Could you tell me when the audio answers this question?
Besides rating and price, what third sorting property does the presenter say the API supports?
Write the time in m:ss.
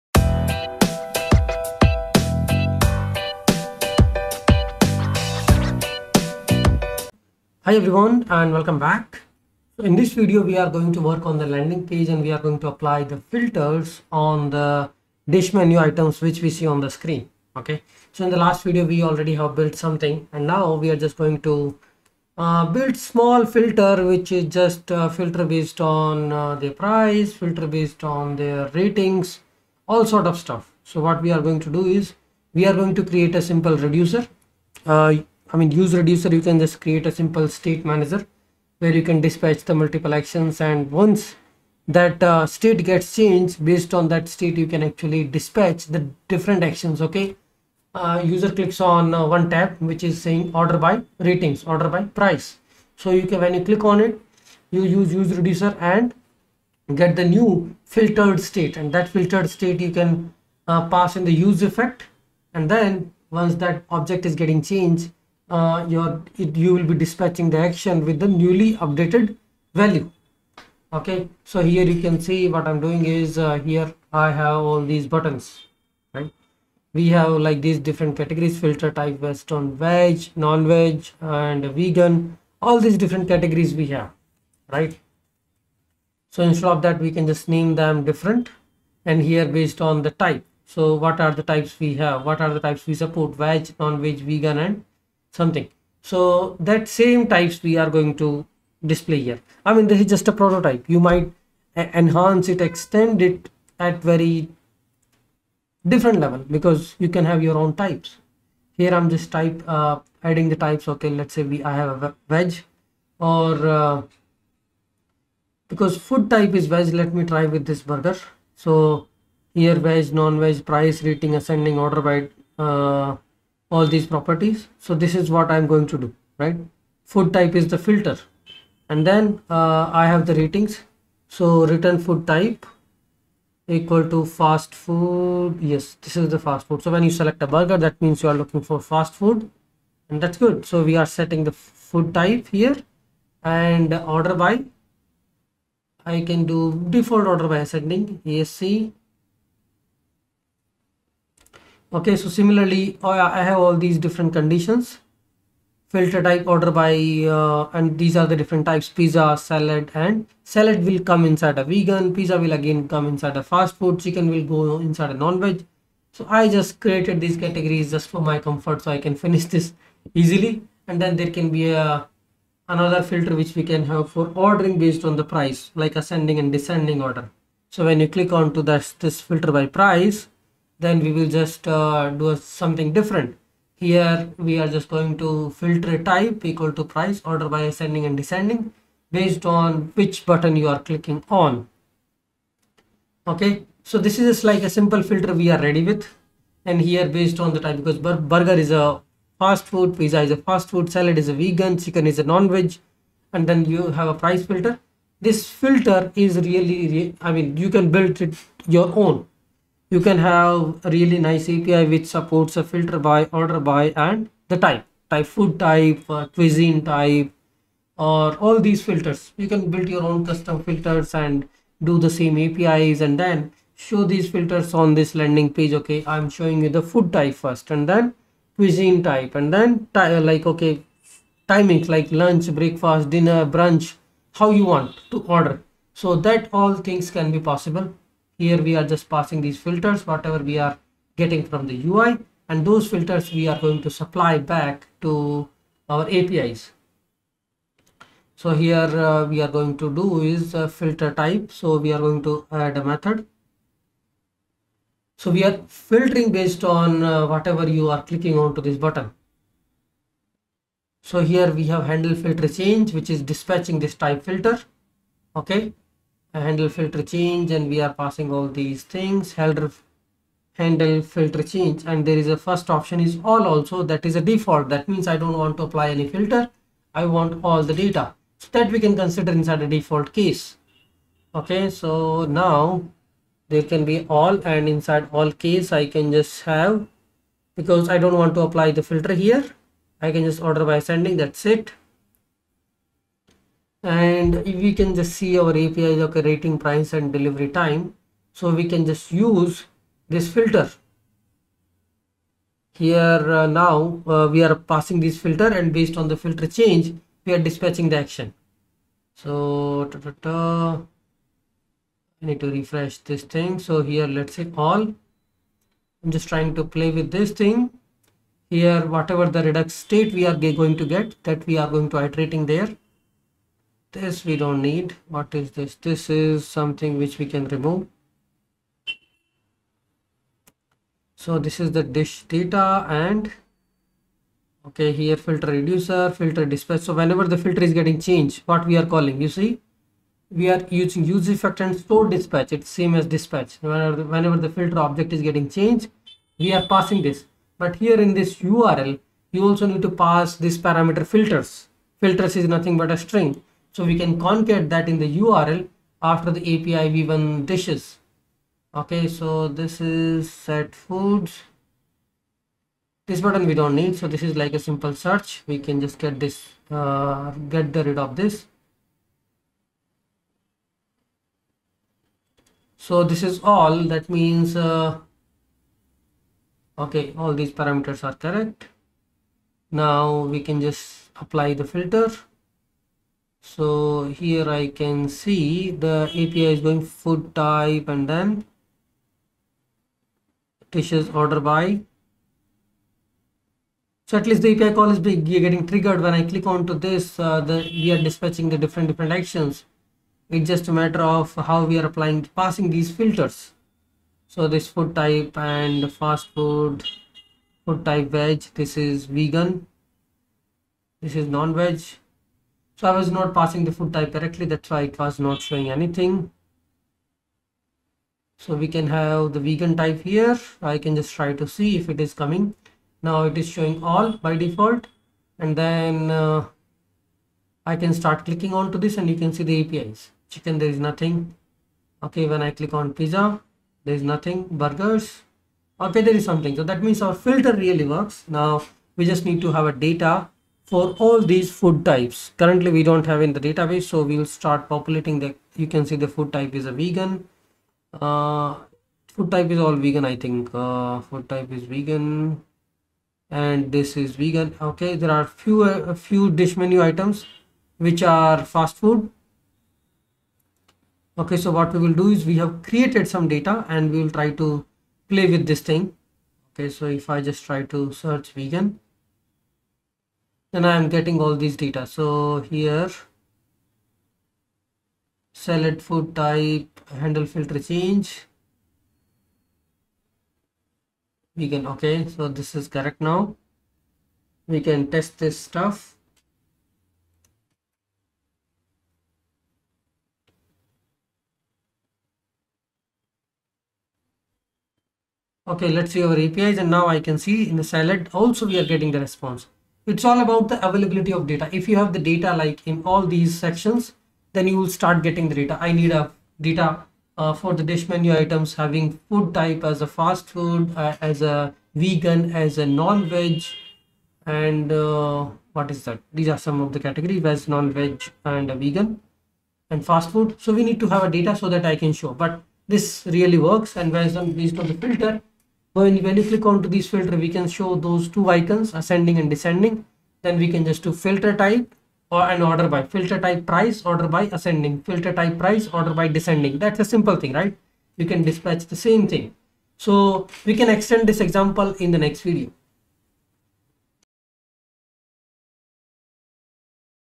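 4:57.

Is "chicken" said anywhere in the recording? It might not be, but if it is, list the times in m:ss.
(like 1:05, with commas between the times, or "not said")
2:43, 3:21, 7:10.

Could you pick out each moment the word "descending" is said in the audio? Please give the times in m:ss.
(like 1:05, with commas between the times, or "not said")
2:56, 3:08, 8:49, 8:56.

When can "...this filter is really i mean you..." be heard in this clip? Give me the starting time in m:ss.
3:25.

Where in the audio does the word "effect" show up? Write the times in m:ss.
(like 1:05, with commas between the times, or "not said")
1:01, 5:41.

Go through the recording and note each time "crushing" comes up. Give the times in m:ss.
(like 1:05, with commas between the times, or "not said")
not said.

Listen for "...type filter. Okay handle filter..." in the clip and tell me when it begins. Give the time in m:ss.
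4:23.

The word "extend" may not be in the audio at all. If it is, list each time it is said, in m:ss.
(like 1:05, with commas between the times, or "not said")
1:42, 9:00.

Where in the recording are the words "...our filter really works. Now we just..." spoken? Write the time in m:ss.
7:17.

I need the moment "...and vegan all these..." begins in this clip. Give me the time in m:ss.
1:21.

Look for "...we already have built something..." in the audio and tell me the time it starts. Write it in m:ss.
0:18.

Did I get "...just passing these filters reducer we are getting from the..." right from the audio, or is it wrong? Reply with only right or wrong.
wrong.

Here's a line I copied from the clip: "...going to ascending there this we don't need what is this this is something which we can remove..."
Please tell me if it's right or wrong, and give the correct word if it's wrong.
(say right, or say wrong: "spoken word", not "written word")
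wrong: "iterating", not "ascending".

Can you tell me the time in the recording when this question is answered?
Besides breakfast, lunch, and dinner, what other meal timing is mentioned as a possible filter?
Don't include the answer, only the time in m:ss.
3:53.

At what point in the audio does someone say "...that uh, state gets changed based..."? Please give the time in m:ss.
0:41.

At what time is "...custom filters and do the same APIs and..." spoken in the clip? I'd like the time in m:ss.
3:40.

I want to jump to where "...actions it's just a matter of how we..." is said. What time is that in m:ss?
6:39.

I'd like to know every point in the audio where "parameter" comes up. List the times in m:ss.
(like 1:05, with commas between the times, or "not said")
5:50, 6:17.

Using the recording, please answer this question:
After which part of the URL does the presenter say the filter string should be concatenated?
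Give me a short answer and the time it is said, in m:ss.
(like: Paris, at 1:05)
API v1 dishes, at 5:56.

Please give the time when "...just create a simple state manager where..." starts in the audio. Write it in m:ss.
0:36.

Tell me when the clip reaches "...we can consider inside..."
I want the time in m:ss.
4:38.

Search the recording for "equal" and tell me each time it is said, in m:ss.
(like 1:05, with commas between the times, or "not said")
2:13, 3:06.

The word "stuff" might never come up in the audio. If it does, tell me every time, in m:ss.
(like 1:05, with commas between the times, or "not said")
0:30, 8:05.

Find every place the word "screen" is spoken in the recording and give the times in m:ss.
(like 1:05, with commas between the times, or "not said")
0:16.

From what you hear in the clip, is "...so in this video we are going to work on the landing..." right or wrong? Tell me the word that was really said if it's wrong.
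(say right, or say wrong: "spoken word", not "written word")
right.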